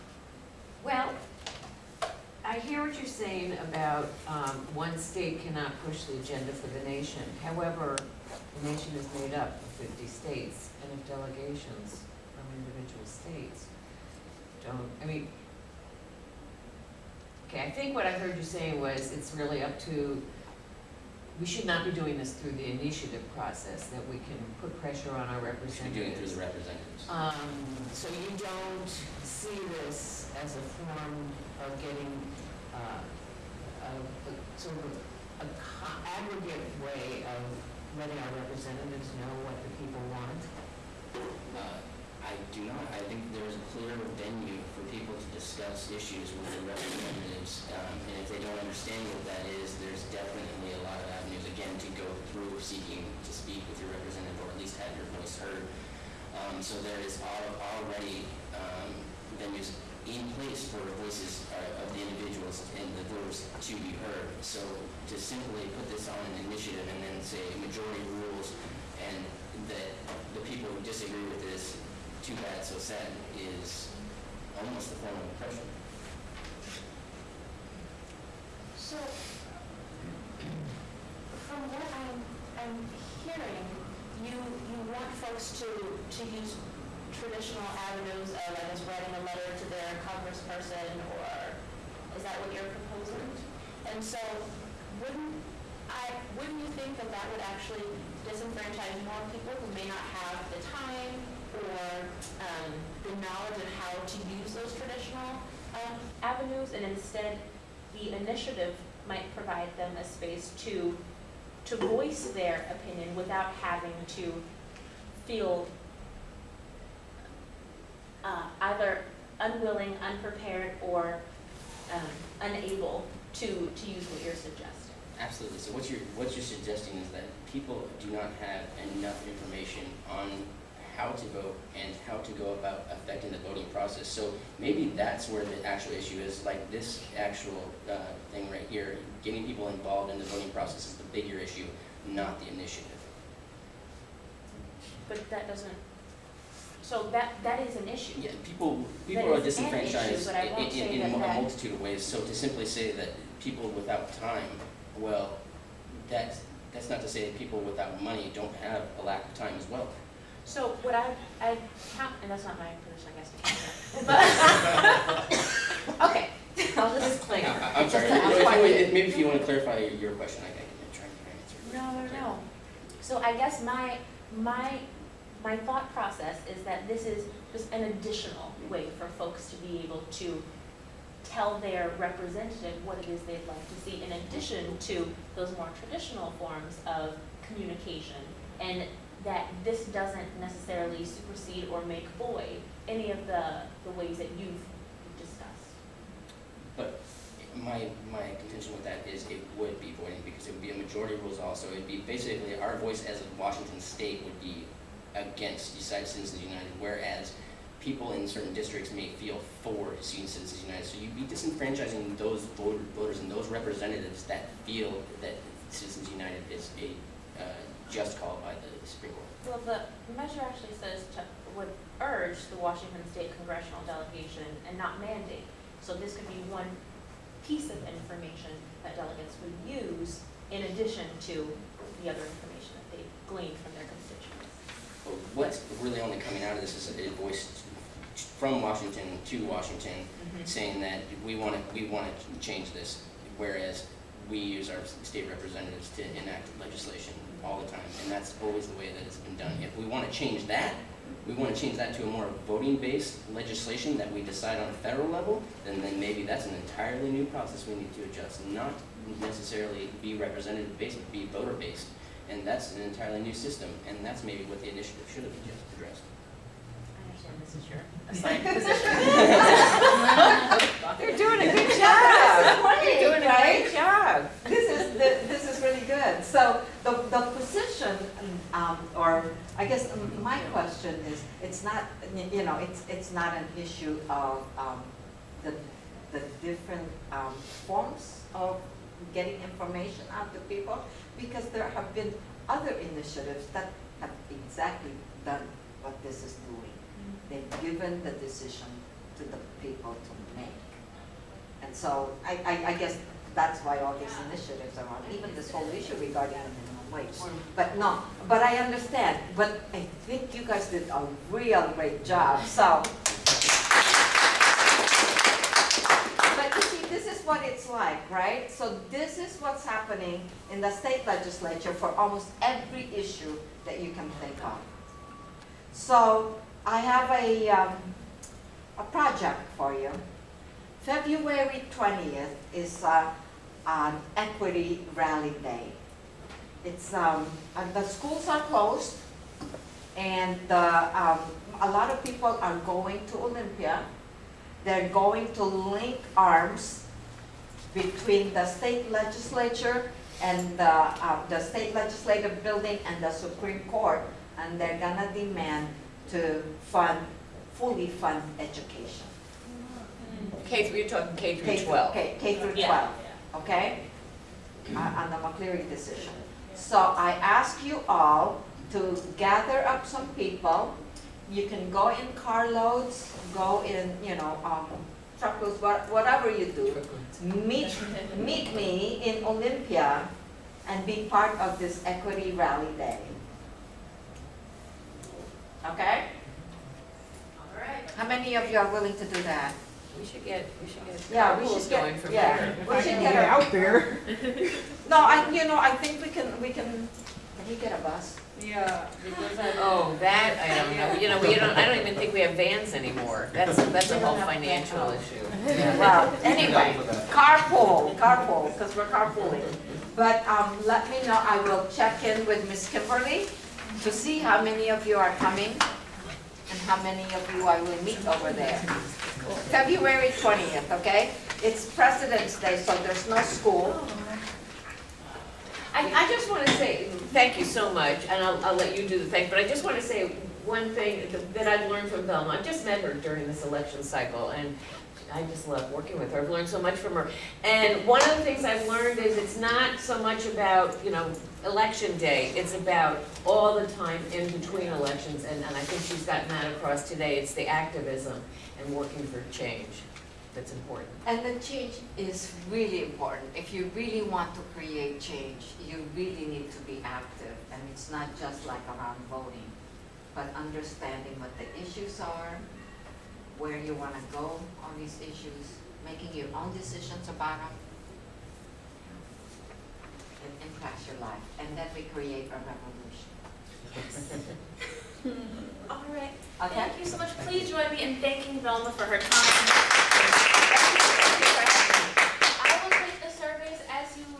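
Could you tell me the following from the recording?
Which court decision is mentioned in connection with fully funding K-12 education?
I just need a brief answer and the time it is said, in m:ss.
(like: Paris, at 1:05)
McCleary decision, at 6:05.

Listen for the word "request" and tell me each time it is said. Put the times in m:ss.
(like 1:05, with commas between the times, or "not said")
not said.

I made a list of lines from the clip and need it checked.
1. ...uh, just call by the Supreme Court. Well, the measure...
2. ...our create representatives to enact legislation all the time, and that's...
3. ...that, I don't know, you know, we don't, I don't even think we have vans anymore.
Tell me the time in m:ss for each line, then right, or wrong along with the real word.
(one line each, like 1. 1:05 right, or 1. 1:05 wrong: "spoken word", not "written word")
1. 3:37 right
2. 4:04 wrong: "state", not "create"
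3. 6:40 right.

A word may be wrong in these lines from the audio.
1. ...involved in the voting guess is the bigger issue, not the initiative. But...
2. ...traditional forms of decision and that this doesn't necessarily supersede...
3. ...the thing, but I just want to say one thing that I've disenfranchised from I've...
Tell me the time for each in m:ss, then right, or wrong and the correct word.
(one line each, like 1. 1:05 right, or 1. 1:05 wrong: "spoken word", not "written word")
1. 2:19 wrong: "process", not "guess"
2. 3:05 wrong: "communication", not "decision"
3. 7:08 wrong: "learned", not "disenfranchised".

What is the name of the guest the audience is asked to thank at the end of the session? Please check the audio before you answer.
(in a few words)
Velma.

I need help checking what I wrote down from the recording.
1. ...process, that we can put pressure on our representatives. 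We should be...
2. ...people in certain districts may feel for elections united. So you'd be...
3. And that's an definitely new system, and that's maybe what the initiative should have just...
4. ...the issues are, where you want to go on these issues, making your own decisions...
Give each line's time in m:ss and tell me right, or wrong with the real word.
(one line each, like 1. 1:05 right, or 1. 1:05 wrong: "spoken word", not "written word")
1. 0:23 right
2. 3:27 wrong: "citizens", not "elections"
3. 4:22 wrong: "entirely", not "definitely"
4. 7:41 right.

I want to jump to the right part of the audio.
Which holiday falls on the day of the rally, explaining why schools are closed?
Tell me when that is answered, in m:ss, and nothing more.
7:01.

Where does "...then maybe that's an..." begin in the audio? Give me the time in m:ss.
4:15.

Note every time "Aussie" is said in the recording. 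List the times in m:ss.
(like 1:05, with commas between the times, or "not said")
not said.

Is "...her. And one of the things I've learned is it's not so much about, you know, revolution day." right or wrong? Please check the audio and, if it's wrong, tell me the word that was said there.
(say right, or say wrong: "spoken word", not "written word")
wrong: "election", not "revolution".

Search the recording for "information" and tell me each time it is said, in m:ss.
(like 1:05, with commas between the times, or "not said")
2:09, 3:47, 3:52, 4:49.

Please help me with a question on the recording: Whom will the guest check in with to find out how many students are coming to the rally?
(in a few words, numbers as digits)
Miss Kimberly.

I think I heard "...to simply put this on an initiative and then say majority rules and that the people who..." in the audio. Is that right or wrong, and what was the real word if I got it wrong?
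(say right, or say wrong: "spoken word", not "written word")
right.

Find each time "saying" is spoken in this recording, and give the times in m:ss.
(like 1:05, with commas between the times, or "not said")
0:03, 0:18, 4:00.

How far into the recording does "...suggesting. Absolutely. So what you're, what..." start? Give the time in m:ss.
2:04.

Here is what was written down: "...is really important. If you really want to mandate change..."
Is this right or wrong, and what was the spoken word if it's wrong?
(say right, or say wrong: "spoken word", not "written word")
wrong: "create", not "mandate".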